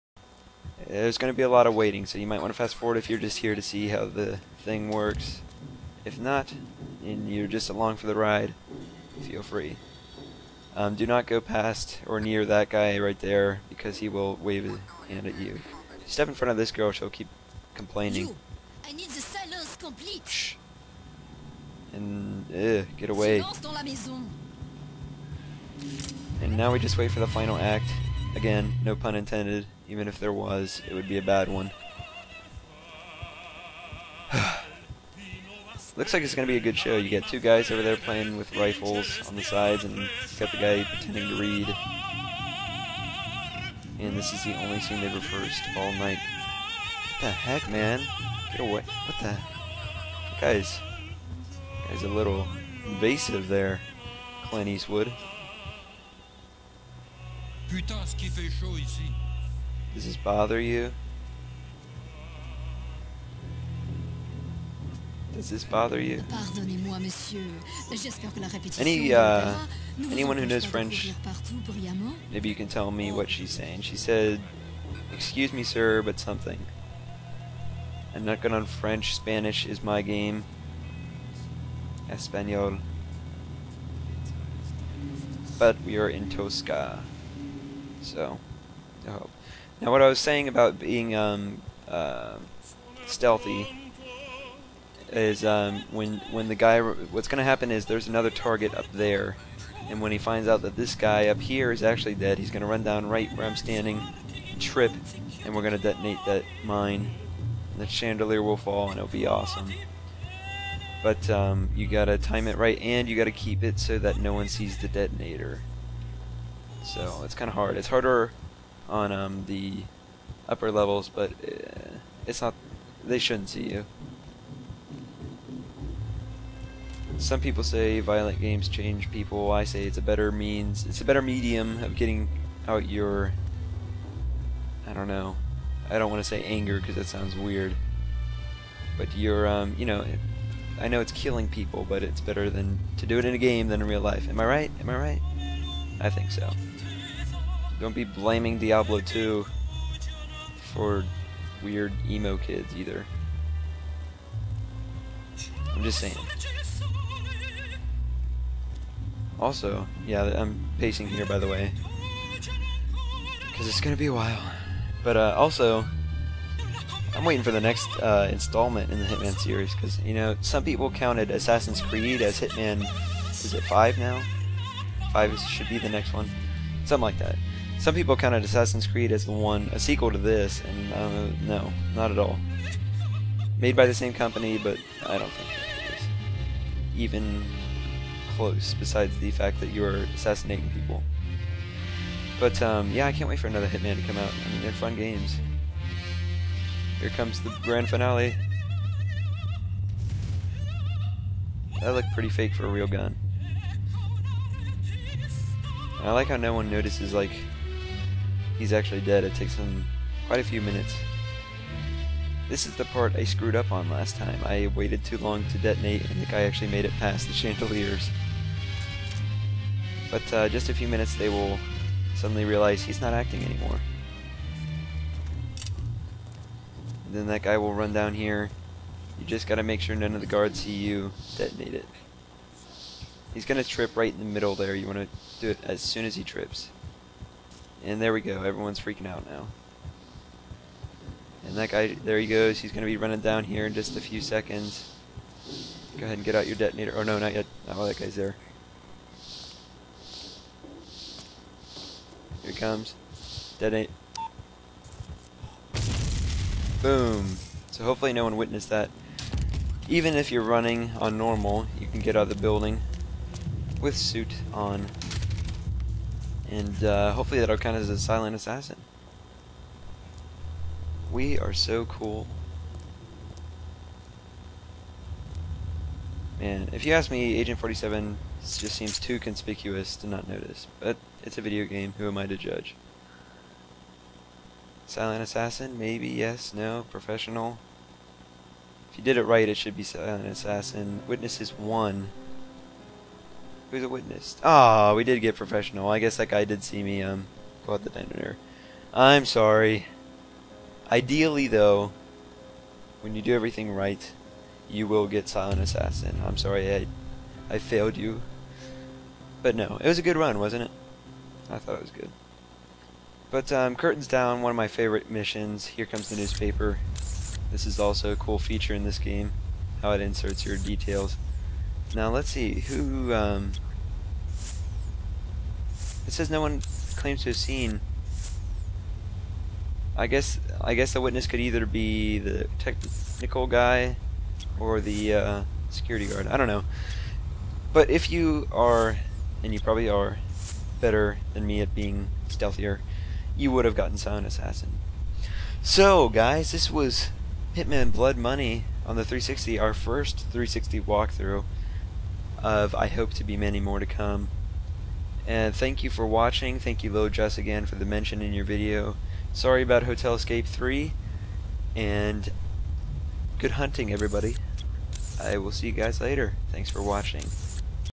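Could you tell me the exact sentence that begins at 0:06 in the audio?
If not, and you're just along for the ride, feel free.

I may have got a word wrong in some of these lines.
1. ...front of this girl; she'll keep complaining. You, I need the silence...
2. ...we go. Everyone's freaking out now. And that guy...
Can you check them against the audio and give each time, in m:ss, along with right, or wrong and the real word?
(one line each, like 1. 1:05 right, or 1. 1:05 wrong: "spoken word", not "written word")
1. 0:16 right
2. 3:58 right.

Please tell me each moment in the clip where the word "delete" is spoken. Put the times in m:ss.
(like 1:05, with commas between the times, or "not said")
not said.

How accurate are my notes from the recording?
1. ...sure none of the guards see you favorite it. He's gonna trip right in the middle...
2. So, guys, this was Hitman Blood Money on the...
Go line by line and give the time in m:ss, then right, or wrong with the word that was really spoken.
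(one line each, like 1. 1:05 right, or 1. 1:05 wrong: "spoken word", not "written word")
1. 3:49 wrong: "detonate", not "favorite"
2. 5:45 right.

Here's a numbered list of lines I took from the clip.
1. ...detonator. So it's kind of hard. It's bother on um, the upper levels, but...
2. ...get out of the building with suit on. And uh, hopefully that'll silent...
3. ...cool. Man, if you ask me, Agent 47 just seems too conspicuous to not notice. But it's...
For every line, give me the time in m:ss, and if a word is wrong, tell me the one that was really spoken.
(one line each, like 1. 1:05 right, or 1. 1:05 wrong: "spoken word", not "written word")
1. 1:54 wrong: "harder", not "bother"
2. 4:21 wrong: "count", not "silent"
3. 4:31 right.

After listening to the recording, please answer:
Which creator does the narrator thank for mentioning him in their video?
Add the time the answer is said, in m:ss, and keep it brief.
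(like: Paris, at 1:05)
LilJuss, at 5:56.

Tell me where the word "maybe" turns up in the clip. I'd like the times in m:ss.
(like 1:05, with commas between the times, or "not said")
1:12, 4:45.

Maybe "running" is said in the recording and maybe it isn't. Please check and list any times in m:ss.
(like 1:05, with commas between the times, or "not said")
4:02, 4:20.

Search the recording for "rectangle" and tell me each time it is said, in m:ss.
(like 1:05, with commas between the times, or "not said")
not said.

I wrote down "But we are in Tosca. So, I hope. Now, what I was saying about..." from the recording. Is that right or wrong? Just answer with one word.
right.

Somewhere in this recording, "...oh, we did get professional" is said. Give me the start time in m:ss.
4:54.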